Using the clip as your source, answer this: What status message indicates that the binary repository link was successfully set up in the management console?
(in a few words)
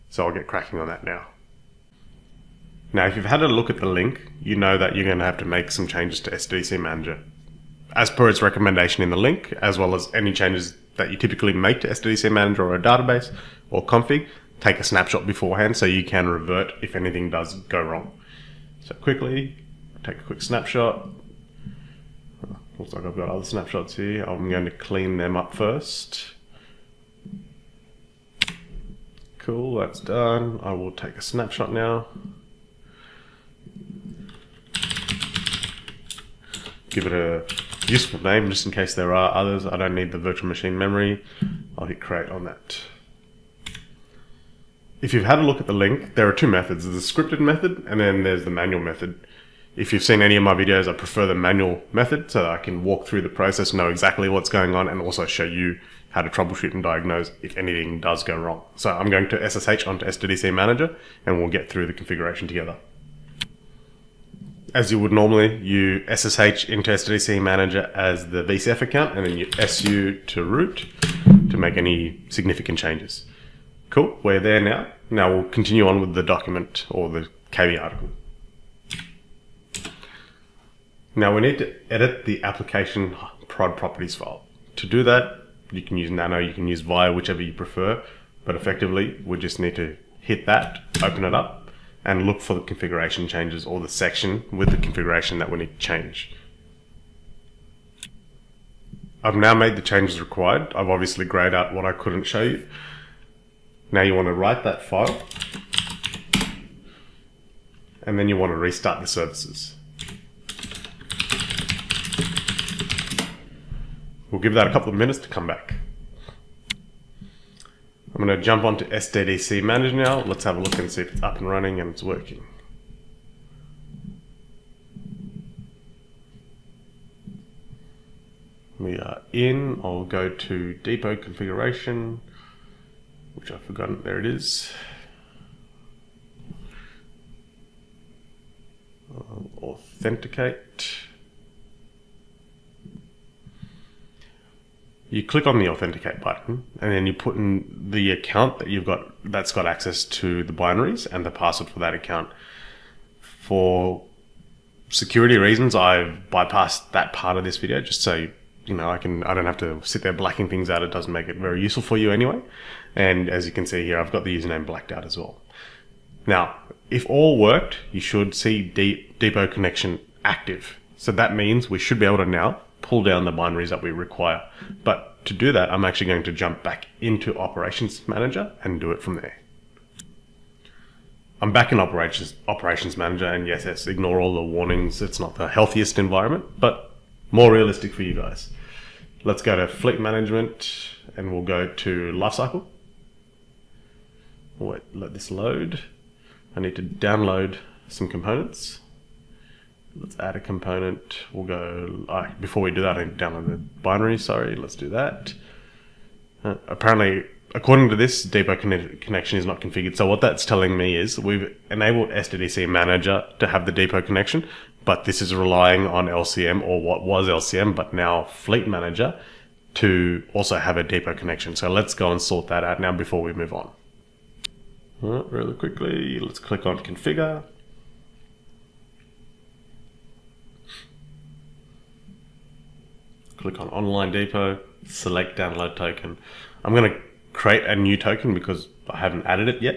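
Depot connection active.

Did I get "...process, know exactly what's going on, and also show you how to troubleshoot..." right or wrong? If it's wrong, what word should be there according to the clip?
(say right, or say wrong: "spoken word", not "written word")
right.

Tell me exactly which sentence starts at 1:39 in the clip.
I've now made the changes required.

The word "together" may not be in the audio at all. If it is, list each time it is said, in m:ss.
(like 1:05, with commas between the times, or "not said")
1:02.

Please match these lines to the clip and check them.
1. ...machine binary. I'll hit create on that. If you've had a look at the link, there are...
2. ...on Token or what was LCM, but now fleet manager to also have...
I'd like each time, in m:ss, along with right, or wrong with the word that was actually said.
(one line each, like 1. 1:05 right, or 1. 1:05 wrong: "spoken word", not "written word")
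1. 0:40 wrong: "memory", not "binary"
2. 3:35 wrong: "LCM", not "Token".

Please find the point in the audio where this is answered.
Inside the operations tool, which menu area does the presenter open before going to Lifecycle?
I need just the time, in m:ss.
3:09.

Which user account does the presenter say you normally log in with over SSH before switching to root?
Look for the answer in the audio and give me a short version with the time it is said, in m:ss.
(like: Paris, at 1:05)
VCF, at 1:08.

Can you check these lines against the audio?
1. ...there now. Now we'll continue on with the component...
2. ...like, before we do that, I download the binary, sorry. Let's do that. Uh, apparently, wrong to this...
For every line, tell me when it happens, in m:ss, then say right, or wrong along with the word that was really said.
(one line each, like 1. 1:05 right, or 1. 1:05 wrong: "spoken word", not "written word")
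1. 1:14 wrong: "document", not "component"
2. 3:22 wrong: "according", not "wrong".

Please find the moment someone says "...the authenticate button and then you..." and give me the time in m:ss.
2:25.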